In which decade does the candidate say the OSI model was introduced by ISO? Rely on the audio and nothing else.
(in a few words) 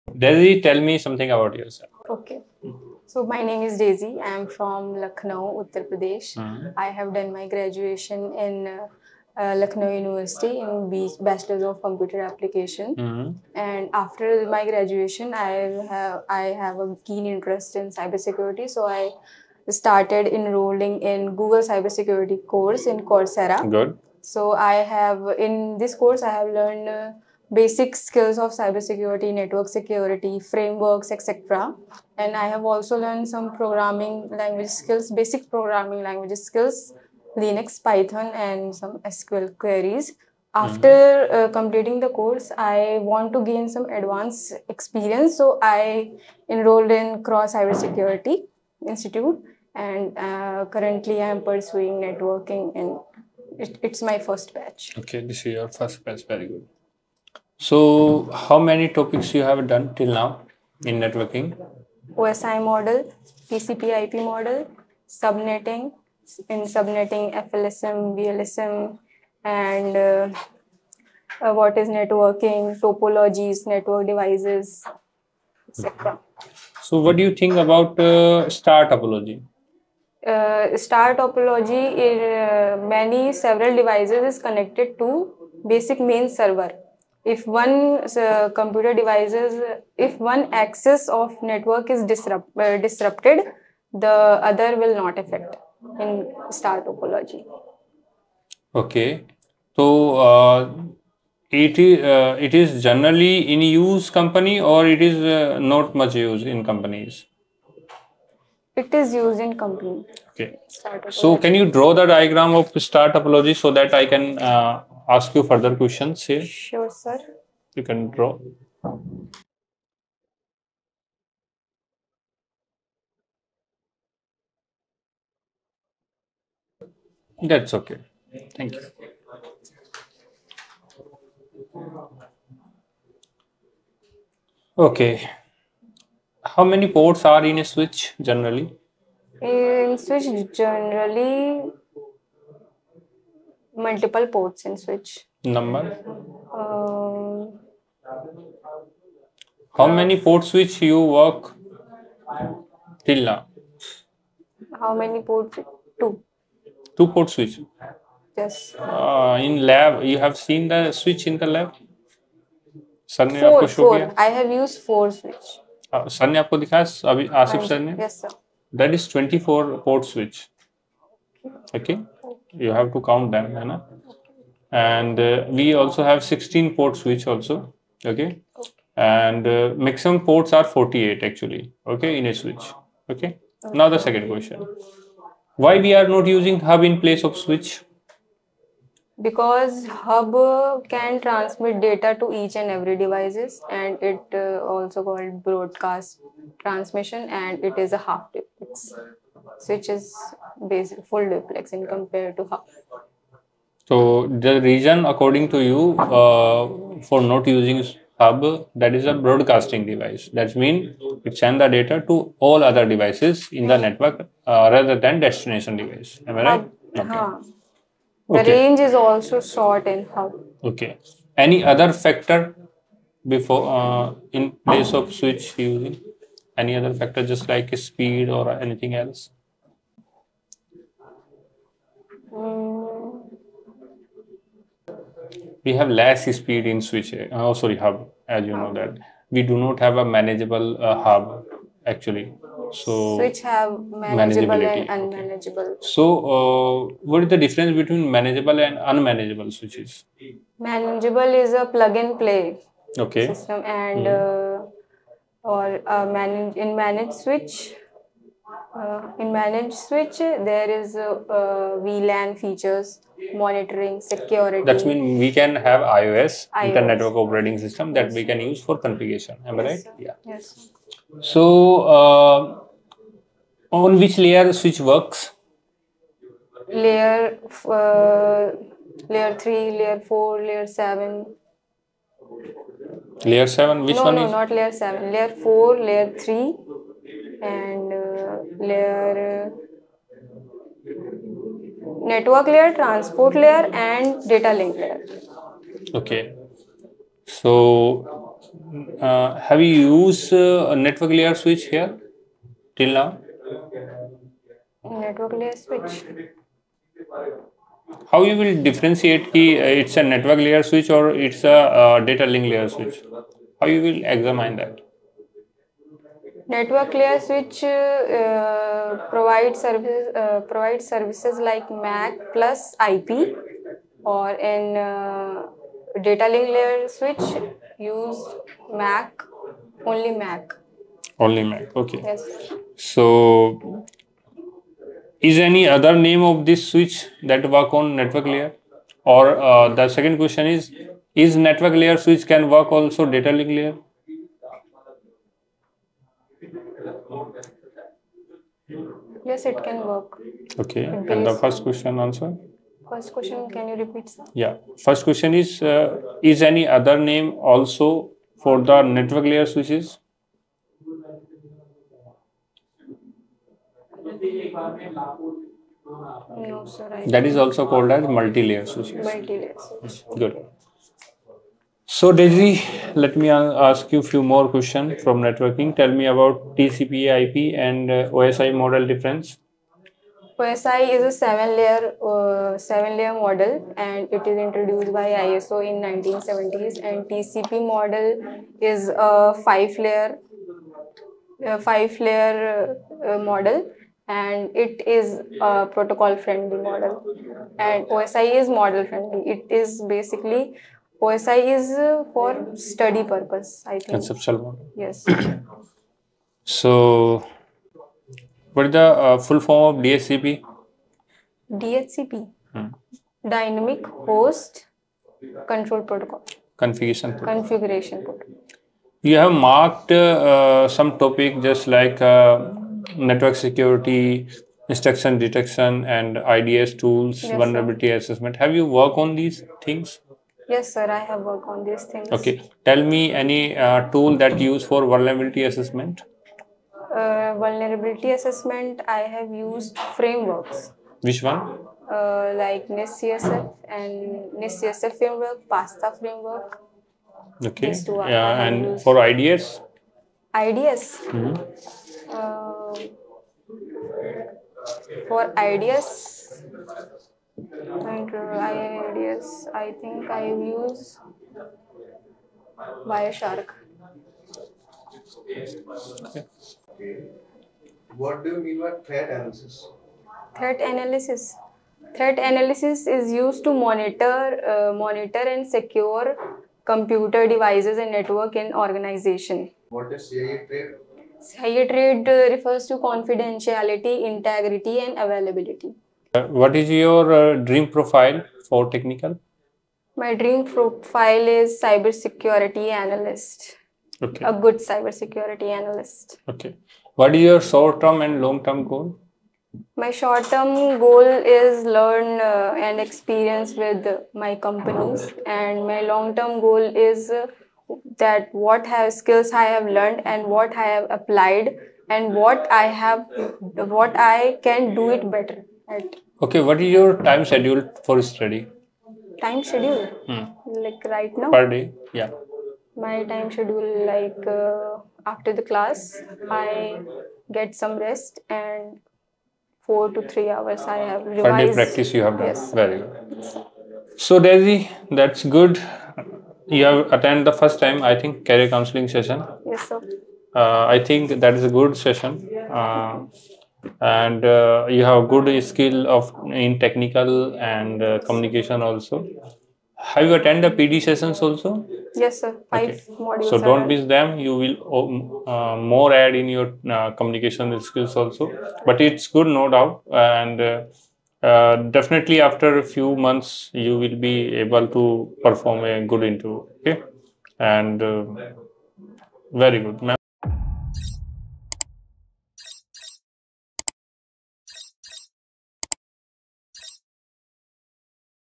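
1970s.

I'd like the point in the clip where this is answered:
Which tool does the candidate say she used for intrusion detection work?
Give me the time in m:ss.
7:42.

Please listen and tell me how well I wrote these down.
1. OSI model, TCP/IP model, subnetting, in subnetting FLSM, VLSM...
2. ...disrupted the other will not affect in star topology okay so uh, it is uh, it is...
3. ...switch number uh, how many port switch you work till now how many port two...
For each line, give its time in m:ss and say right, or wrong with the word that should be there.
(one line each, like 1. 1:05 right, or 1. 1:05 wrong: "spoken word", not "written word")
1. 1:02 right
2. 1:32 right
3. 2:24 right.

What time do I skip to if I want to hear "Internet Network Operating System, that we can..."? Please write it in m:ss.
4:26.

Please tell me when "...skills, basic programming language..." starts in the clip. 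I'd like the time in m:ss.
0:34.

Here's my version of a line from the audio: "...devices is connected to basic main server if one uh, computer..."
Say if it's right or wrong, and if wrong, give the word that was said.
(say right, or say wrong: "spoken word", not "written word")
right.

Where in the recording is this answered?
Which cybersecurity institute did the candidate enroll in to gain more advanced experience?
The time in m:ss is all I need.
0:47.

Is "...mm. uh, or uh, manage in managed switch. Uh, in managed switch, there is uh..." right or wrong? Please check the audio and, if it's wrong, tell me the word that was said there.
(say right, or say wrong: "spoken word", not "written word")
right.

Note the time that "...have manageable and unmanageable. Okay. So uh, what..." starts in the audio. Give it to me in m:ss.
4:03.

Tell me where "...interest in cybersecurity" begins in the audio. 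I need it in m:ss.
0:17.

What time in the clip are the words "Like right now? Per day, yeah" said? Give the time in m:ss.
8:40.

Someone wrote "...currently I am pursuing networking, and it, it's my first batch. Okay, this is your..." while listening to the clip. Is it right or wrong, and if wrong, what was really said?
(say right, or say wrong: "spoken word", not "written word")
right.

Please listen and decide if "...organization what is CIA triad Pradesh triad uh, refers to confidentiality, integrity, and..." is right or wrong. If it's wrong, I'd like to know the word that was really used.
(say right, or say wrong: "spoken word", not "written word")
wrong: "CIA", not "Pradesh".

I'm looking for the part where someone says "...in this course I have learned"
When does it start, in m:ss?
0:25.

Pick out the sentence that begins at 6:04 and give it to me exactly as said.
That is also called as multi-layer switches.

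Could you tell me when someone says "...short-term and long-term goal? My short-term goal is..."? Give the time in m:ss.
8:17.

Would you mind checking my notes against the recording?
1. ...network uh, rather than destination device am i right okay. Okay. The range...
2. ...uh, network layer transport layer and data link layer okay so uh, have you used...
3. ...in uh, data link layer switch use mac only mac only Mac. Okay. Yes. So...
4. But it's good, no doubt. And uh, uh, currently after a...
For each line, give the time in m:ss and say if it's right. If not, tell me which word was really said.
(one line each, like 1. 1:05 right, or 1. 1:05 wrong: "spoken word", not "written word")
1. 3:33 right
2. 4:49 right
3. 5:24 right
4. 9:18 wrong: "definitely", not "currently".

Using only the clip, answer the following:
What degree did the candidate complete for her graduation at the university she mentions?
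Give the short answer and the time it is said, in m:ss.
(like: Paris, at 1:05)
Bachelor's of Computer Application, at 0:11.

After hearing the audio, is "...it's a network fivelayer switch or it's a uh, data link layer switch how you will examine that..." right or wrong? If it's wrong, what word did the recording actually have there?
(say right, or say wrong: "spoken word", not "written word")
wrong: "layer", not "fivelayer".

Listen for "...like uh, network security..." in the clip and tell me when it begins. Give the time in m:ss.
7:01.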